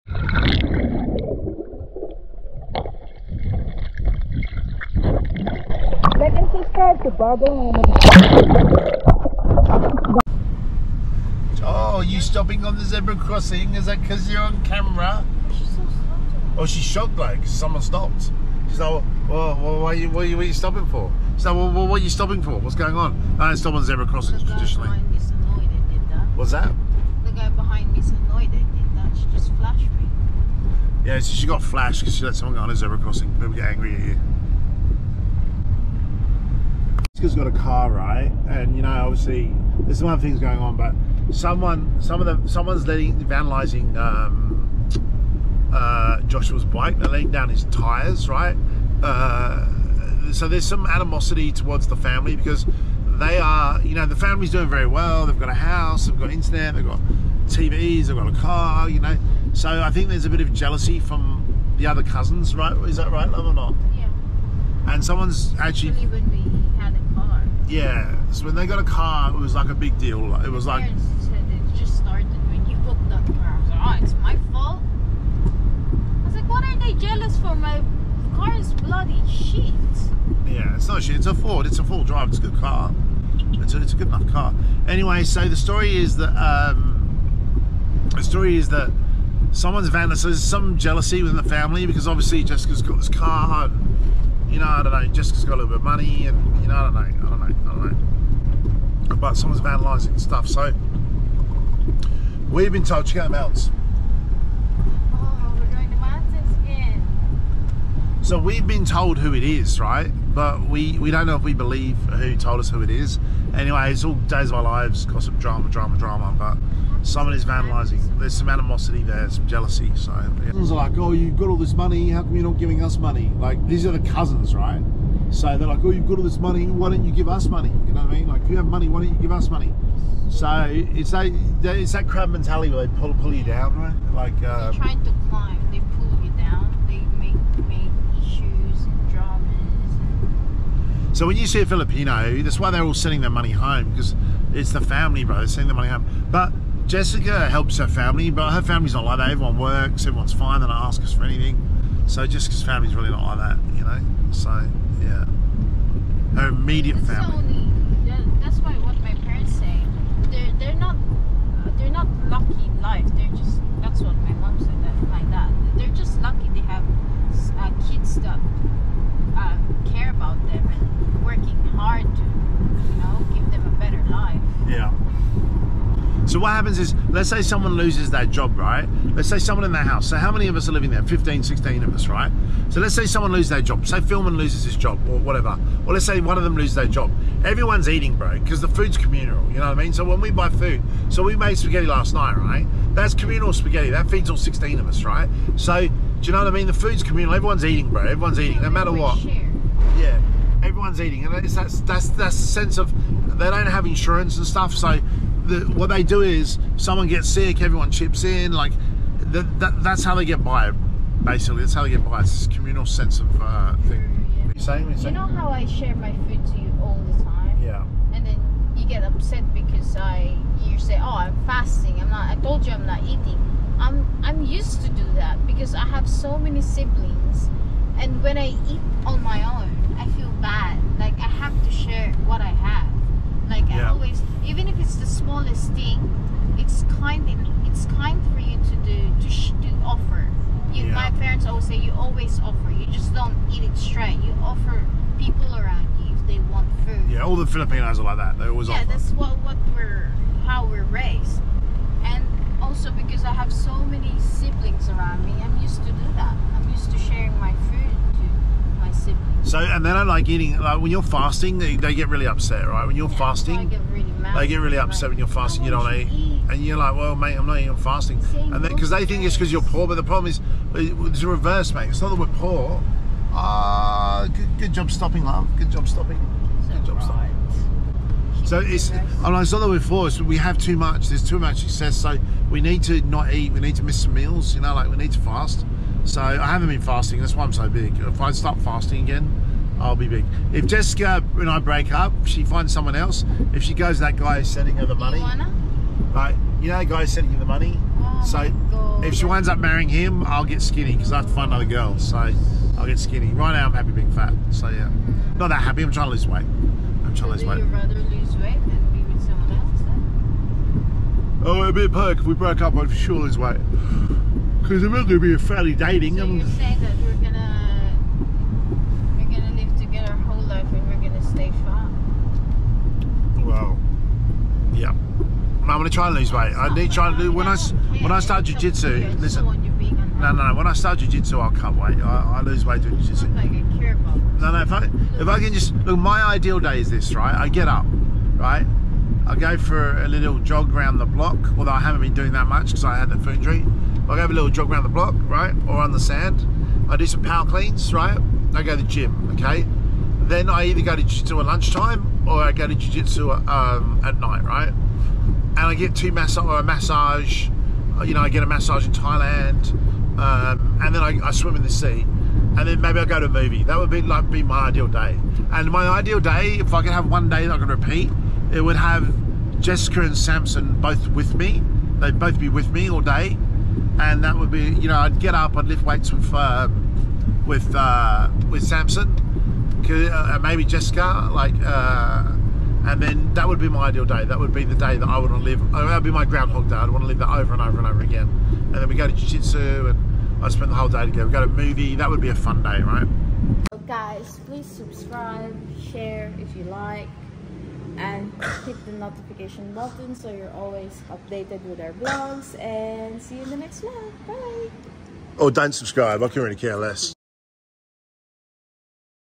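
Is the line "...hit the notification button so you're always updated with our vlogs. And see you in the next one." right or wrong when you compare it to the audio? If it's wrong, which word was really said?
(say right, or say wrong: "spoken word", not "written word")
right.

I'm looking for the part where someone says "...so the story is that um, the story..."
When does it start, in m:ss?
1:25.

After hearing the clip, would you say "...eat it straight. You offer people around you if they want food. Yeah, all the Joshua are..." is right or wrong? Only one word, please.
wrong.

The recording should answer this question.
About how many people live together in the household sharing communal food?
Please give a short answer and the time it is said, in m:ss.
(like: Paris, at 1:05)
15 or 16, at 3:01.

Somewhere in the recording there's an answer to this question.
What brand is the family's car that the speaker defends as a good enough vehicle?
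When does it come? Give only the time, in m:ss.
1:21.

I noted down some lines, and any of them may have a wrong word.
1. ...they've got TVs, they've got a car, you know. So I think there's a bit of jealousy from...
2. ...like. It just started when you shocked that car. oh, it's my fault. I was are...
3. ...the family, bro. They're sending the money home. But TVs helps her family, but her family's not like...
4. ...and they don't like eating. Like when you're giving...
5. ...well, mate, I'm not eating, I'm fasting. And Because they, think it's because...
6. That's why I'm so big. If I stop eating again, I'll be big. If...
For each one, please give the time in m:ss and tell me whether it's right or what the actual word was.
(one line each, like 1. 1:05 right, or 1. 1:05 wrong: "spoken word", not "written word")
1. 0:56 right
2. 1:10 wrong: "booked", not "shocked"
3. 2:24 wrong: "Jessica", not "TVs"
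4. 4:19 wrong: "fasting", not "giving"
5. 4:26 right
6. 4:47 wrong: "fasting", not "eating".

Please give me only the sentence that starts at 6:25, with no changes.
Uh, that would be my groundhog day.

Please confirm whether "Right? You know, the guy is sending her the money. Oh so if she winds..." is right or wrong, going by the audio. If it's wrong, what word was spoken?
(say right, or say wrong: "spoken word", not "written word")
right.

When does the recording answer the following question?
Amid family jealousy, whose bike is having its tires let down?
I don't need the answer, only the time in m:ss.
0:46.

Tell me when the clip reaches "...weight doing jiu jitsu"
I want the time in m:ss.
5:32.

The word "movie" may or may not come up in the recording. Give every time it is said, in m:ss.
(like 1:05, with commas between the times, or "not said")
6:03, 6:31.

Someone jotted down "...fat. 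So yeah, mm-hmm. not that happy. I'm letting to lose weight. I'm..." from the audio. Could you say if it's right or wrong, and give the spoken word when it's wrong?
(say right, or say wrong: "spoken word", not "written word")
wrong: "trying", not "letting".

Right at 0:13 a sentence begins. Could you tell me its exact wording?
Is that because you're on camera?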